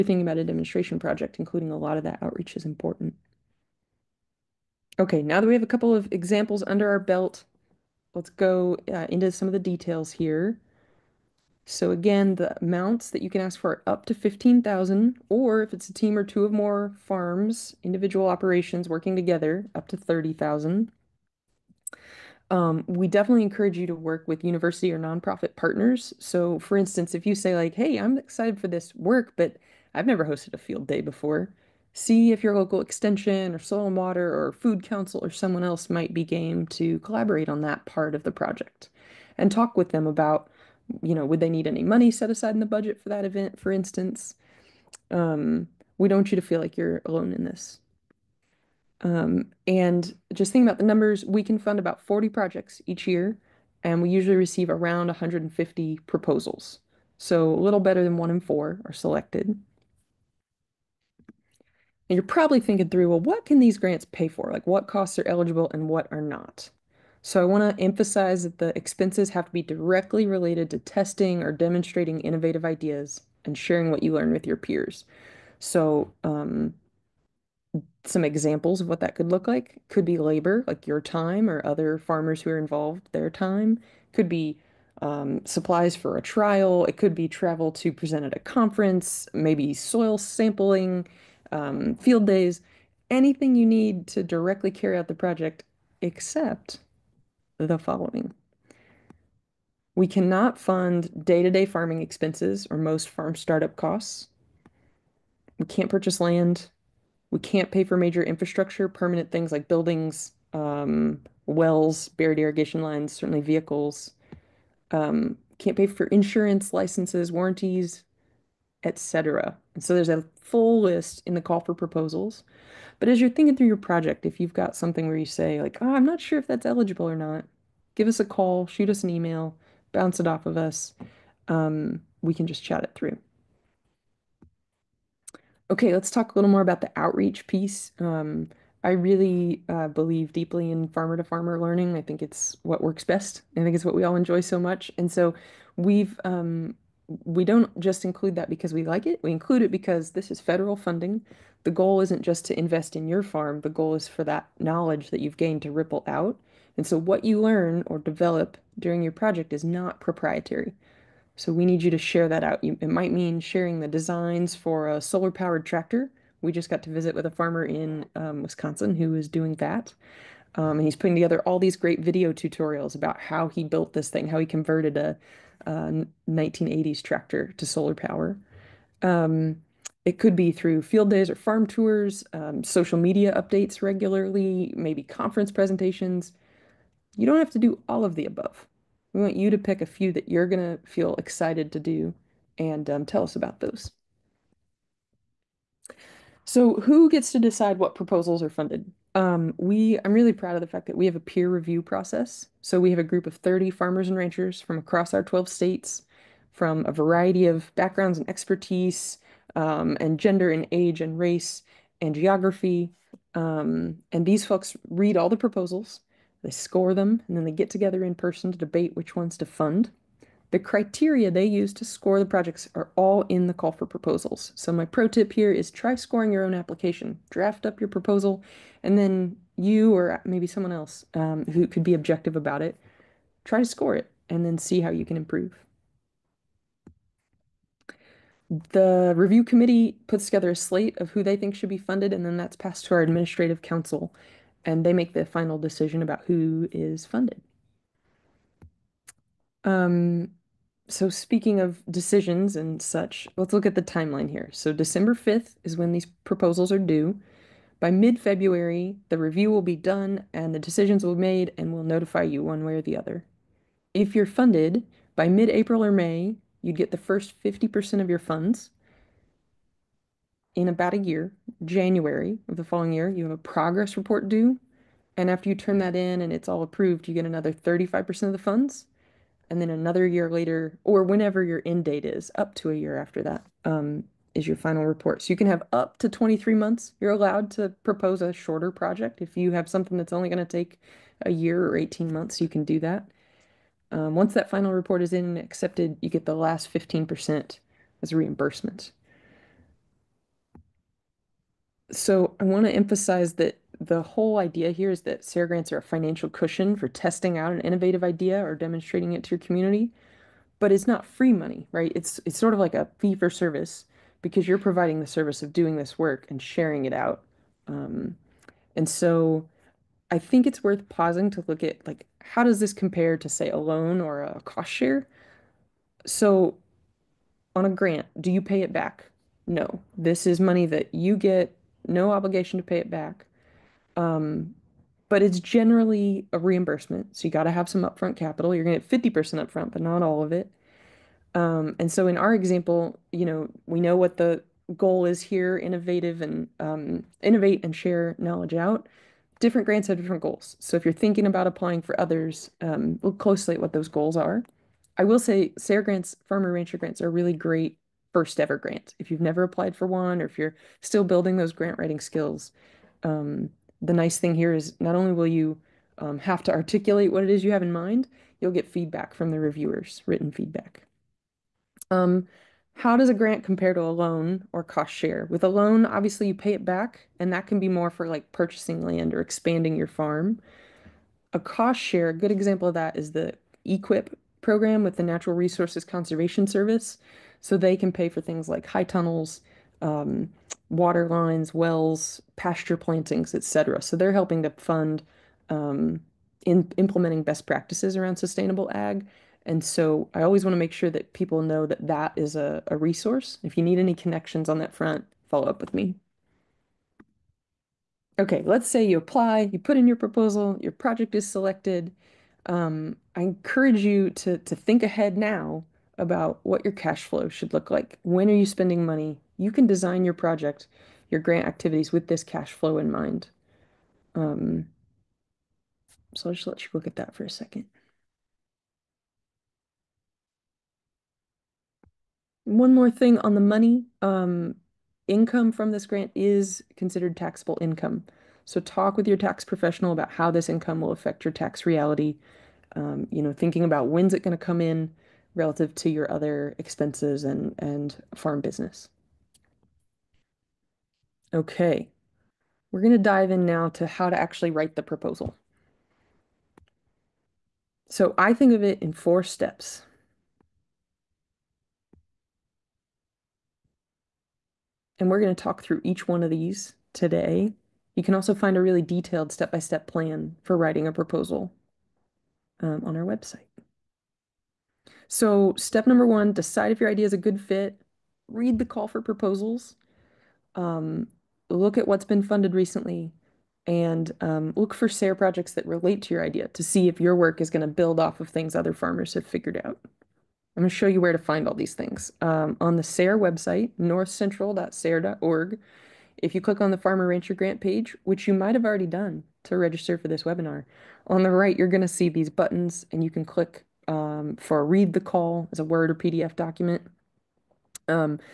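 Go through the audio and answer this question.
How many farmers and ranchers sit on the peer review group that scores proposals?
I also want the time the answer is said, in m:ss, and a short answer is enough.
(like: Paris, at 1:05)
30, at 3:23.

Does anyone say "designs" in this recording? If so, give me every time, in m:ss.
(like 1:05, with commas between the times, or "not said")
2:43, 6:59.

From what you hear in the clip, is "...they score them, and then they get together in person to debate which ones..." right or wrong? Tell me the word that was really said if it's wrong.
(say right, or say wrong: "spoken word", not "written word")
right.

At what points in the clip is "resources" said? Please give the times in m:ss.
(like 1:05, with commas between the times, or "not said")
6:25, 6:42.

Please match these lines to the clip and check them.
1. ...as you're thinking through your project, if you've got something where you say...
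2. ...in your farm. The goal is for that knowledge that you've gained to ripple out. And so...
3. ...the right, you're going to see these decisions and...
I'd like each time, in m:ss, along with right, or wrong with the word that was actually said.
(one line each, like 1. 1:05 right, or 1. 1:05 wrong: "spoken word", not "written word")
1. 2:03 right
2. 2:32 right
3. 8:21 wrong: "buttons", not "decisions".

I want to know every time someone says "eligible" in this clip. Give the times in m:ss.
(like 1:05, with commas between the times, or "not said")
1:05, 2:06.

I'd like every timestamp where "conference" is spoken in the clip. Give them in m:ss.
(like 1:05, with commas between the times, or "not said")
1:28, 3:05.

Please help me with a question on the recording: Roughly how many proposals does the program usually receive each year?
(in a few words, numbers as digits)
150.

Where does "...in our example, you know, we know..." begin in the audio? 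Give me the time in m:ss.
5:42.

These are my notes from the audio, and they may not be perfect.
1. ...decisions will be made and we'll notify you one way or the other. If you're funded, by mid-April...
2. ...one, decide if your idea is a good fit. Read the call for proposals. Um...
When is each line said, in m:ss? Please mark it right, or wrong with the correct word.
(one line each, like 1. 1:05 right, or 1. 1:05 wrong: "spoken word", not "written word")
1. 4:20 right
2. 7:56 right.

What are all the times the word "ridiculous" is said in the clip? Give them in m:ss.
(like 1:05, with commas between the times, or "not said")
not said.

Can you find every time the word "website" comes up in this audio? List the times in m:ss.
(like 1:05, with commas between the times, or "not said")
7:53, 8:13.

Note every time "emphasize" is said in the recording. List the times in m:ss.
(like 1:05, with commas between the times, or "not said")
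1:07, 5:02.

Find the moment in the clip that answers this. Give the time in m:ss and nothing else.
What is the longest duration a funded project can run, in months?
4:46.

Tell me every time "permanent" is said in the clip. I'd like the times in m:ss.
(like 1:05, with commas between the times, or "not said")
1:48.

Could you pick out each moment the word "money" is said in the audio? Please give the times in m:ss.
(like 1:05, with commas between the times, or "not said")
0:41, 5:11, 5:30, 6:58, 7:13.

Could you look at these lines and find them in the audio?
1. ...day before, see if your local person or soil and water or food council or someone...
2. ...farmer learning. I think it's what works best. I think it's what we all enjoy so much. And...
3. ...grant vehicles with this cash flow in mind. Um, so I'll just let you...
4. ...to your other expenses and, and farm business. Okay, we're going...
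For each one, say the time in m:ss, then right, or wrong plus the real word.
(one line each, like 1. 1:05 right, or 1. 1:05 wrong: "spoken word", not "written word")
1. 0:30 wrong: "extension", not "person"
2. 2:21 right
3. 7:01 wrong: "activities", not "vehicles"
4. 7:25 right.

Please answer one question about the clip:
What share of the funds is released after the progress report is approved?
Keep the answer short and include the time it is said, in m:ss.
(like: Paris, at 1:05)
35%, at 4:37.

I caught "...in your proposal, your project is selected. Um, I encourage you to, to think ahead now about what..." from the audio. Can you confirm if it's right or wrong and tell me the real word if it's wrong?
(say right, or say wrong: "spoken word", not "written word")
right.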